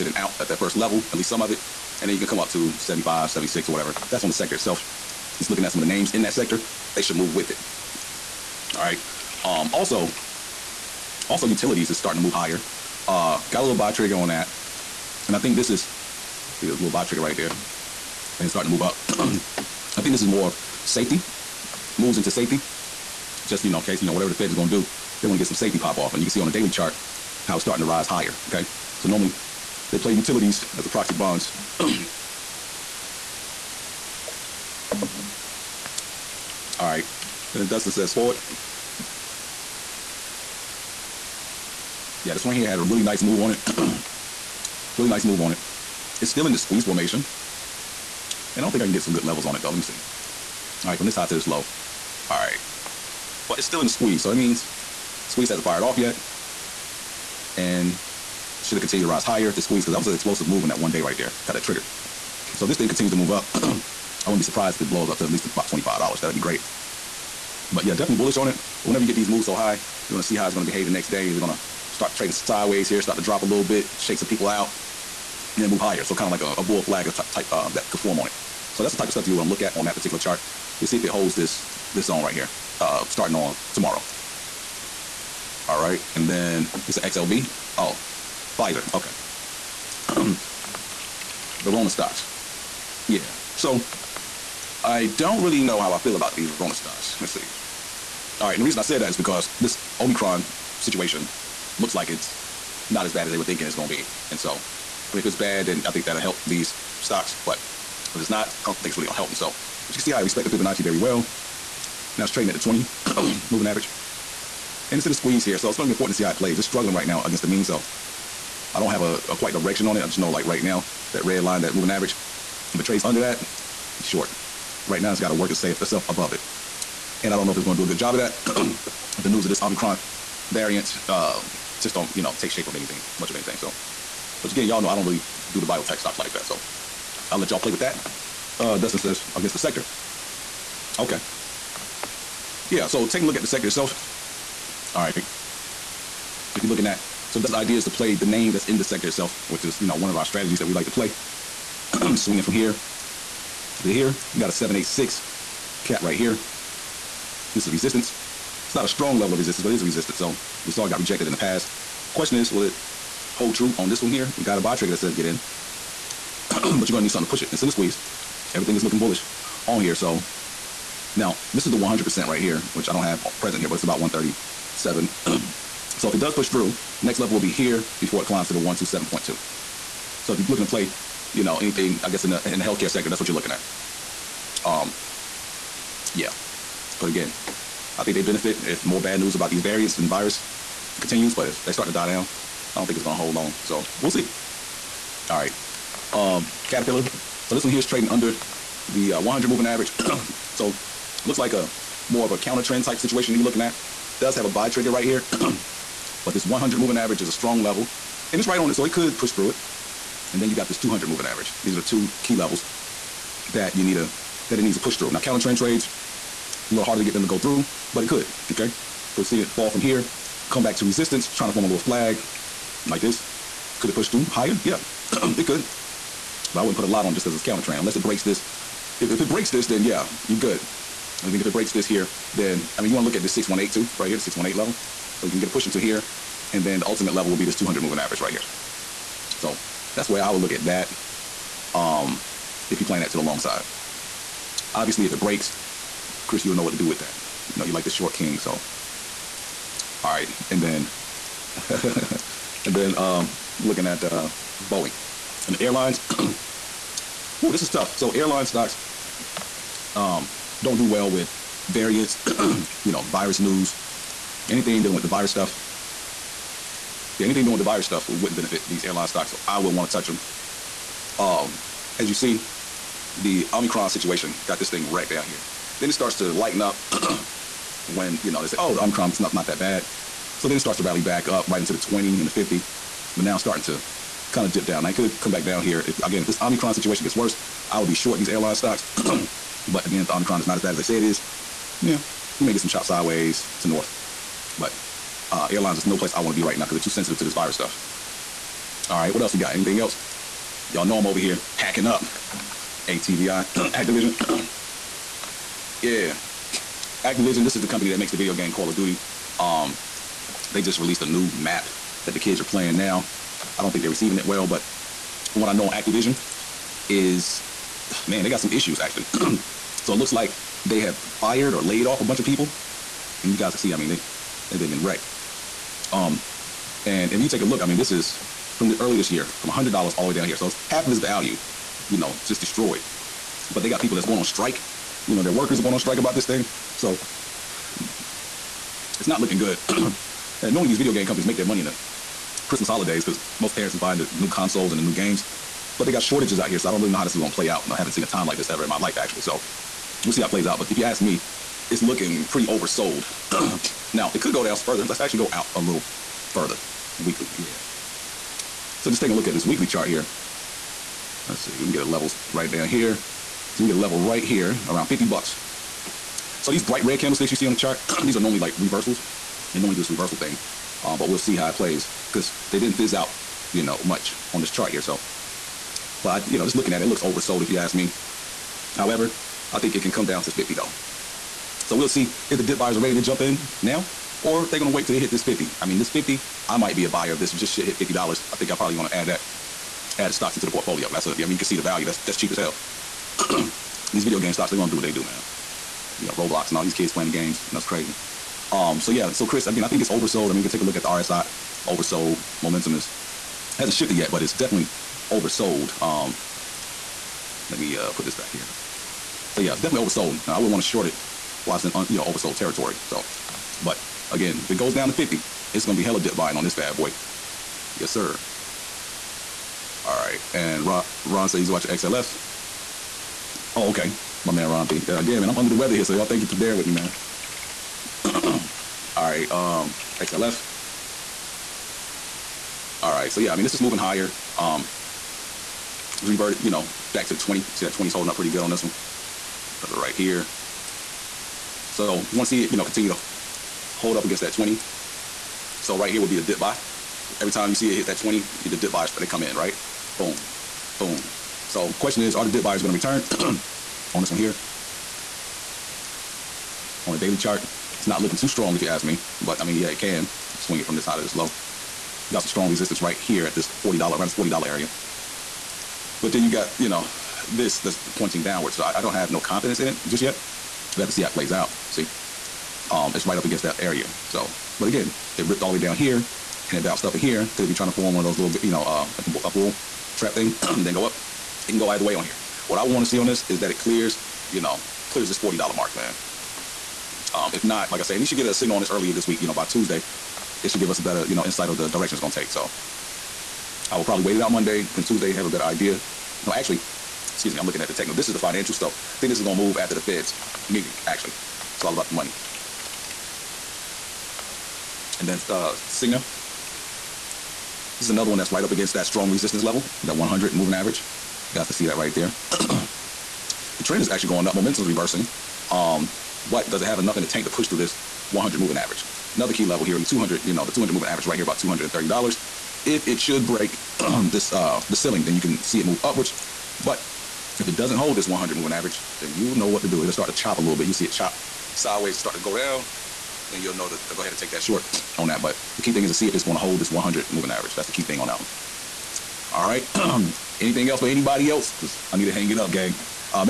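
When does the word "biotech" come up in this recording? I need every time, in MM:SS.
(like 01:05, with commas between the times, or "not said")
02:15.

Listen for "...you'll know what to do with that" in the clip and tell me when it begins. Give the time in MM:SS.
04:06.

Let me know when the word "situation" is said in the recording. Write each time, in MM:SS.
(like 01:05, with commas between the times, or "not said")
01:40, 03:22, 04:33, 04:46.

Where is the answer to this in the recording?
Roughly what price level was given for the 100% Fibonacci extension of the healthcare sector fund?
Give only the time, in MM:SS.
02:53.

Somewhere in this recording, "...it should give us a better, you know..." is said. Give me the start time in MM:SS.
08:10.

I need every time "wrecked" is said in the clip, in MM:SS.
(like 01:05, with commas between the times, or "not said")
04:34, 05:24.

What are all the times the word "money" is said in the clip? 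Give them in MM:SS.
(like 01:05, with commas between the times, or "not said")
05:41, 08:21.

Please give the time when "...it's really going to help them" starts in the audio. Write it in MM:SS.
01:48.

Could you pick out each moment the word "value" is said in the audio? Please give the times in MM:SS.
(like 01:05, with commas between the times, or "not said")
05:30, 06:31.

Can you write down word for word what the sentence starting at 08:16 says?
No, actually, excuse me, I'm looking at the techno.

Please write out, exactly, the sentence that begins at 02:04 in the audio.
Right now, it's got to work itself above it.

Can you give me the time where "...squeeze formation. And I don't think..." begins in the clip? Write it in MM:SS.
00:46.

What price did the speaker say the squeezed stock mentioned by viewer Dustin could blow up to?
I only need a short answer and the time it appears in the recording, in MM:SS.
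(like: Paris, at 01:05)
$25, at 01:05.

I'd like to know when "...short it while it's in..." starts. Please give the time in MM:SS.
06:50.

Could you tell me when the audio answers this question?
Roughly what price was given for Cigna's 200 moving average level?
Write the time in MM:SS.
08:41.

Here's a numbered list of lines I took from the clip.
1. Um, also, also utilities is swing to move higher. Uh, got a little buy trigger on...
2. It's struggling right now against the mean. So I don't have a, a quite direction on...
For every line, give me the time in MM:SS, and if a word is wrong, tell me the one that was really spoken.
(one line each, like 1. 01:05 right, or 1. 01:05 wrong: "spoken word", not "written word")
1. 00:09 wrong: "starting", not "swing"
2. 01:56 right.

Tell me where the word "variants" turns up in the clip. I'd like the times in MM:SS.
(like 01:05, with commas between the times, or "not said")
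02:10, 03:09, 04:21.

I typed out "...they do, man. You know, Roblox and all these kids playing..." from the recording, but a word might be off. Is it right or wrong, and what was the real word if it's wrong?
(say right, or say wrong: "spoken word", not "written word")
right.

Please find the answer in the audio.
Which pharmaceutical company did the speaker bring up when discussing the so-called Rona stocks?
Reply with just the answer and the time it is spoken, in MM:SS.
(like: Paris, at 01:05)
Pfizer, at 01:28.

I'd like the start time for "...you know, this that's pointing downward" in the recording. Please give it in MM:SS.
07:46.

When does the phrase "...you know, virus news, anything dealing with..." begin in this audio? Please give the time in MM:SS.
04:22.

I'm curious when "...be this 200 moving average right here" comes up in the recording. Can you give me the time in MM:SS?
03:57.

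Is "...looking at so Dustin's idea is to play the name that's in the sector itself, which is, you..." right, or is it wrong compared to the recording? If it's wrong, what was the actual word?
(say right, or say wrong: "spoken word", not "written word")
right.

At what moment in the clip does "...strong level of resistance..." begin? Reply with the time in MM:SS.
02:38.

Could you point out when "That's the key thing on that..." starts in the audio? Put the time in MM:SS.
08:57.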